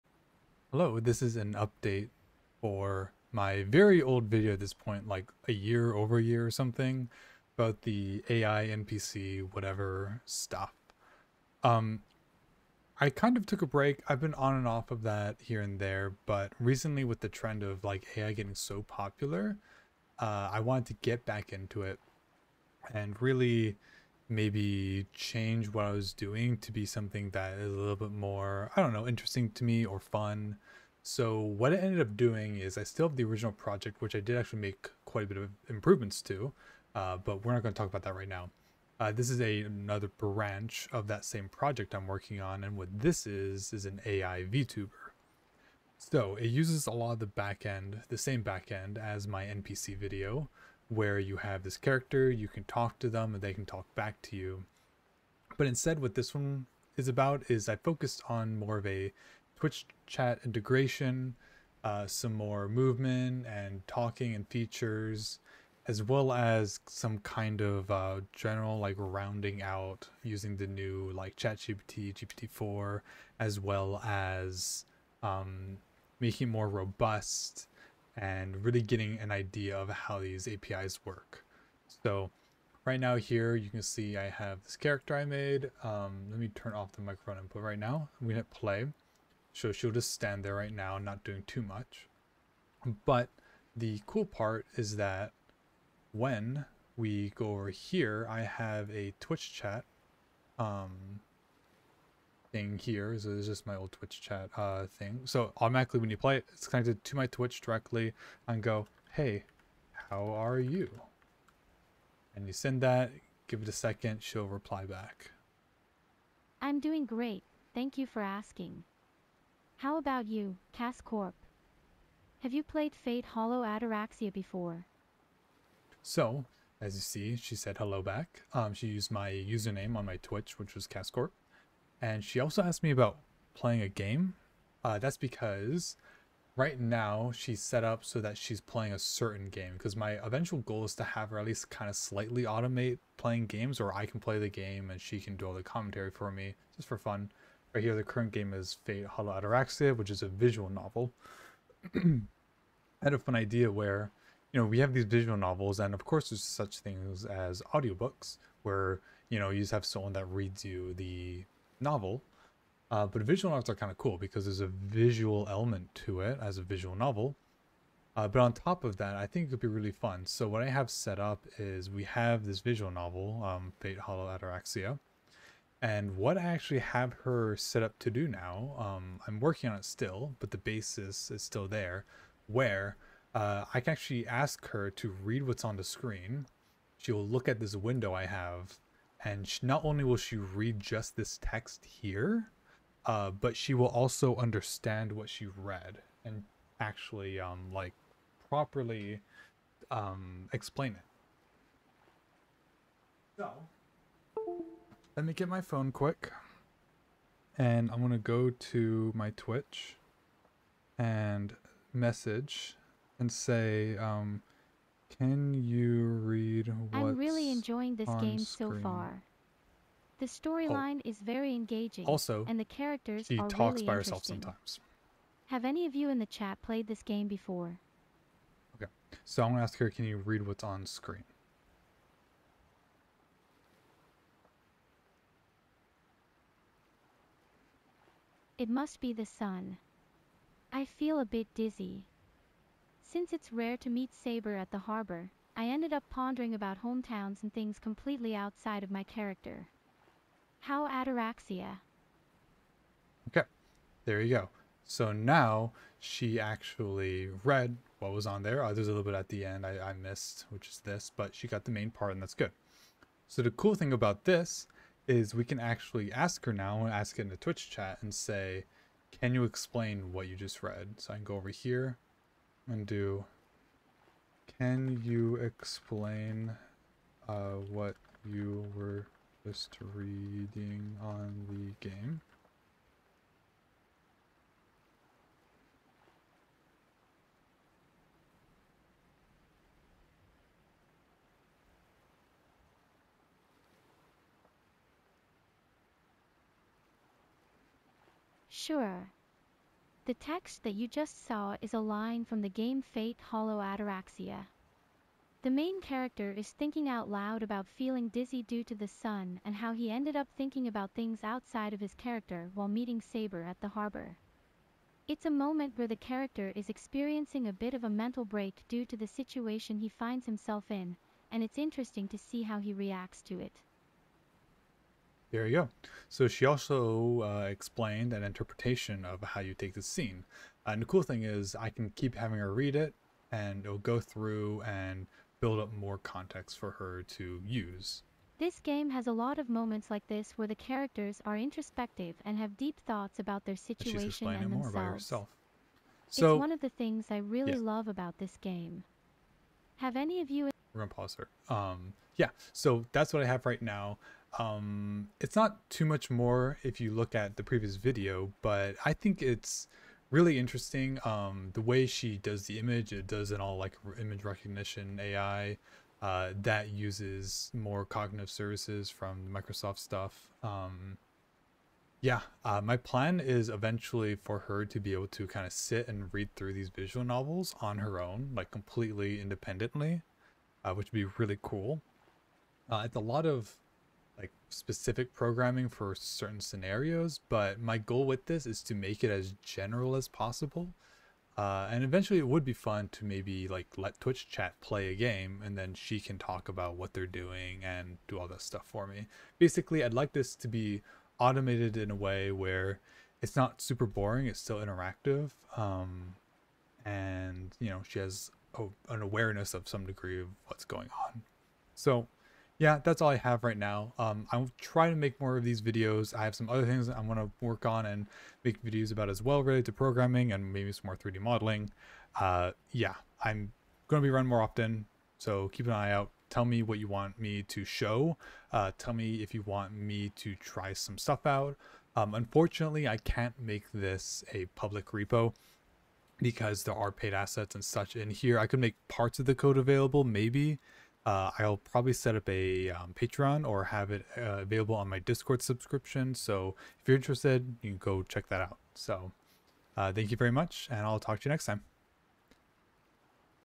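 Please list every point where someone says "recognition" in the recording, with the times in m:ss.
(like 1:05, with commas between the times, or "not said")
6:04.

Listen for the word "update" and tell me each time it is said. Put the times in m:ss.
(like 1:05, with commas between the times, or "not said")
0:01.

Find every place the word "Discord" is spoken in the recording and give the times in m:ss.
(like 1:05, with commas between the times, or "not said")
7:24.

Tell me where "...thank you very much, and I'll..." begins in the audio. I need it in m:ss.
7:29.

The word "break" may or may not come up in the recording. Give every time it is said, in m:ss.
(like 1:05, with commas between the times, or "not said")
0:13, 5:18.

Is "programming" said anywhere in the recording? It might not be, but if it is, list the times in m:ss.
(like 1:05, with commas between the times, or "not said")
6:25, 6:59.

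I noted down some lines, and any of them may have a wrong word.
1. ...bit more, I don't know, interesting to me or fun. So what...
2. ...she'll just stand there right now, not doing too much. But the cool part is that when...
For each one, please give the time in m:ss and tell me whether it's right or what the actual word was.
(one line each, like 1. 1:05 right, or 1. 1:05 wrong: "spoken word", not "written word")
1. 0:27 right
2. 1:29 right.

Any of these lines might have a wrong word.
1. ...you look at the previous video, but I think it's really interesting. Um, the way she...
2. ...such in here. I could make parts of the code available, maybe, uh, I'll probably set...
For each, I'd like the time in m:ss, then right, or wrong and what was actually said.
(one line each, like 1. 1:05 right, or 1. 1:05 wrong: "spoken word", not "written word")
1. 5:56 right
2. 7:17 right.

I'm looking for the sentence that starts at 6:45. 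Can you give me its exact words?
Um, and you know, she has a, an awareness of some degree of what's going on.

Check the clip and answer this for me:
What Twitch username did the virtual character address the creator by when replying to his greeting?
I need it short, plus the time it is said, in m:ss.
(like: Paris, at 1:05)
Cascorp, at 2:10.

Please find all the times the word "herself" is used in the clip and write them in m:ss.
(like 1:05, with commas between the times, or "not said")
3:43, 5:44.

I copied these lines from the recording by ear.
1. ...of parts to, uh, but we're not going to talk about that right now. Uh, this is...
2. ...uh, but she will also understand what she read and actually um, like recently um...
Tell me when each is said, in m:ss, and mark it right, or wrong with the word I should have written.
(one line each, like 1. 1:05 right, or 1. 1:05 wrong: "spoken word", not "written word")
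1. 0:35 wrong: "improvements", not "parts"
2. 3:13 wrong: "properly", not "recently".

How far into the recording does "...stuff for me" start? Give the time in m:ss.
6:38.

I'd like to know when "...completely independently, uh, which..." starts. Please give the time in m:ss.
6:18.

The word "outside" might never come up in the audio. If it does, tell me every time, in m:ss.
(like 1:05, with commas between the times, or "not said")
4:08, 5:11.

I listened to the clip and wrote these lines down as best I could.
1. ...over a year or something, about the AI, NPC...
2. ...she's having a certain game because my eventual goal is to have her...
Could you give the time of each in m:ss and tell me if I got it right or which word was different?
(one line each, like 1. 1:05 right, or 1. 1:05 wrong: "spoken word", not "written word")
1. 0:05 right
2. 2:18 wrong: "playing", not "having".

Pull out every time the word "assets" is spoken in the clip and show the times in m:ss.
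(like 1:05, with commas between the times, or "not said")
7:17.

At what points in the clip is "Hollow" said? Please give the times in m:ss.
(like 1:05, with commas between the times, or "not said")
2:03, 2:29, 2:53, 5:03.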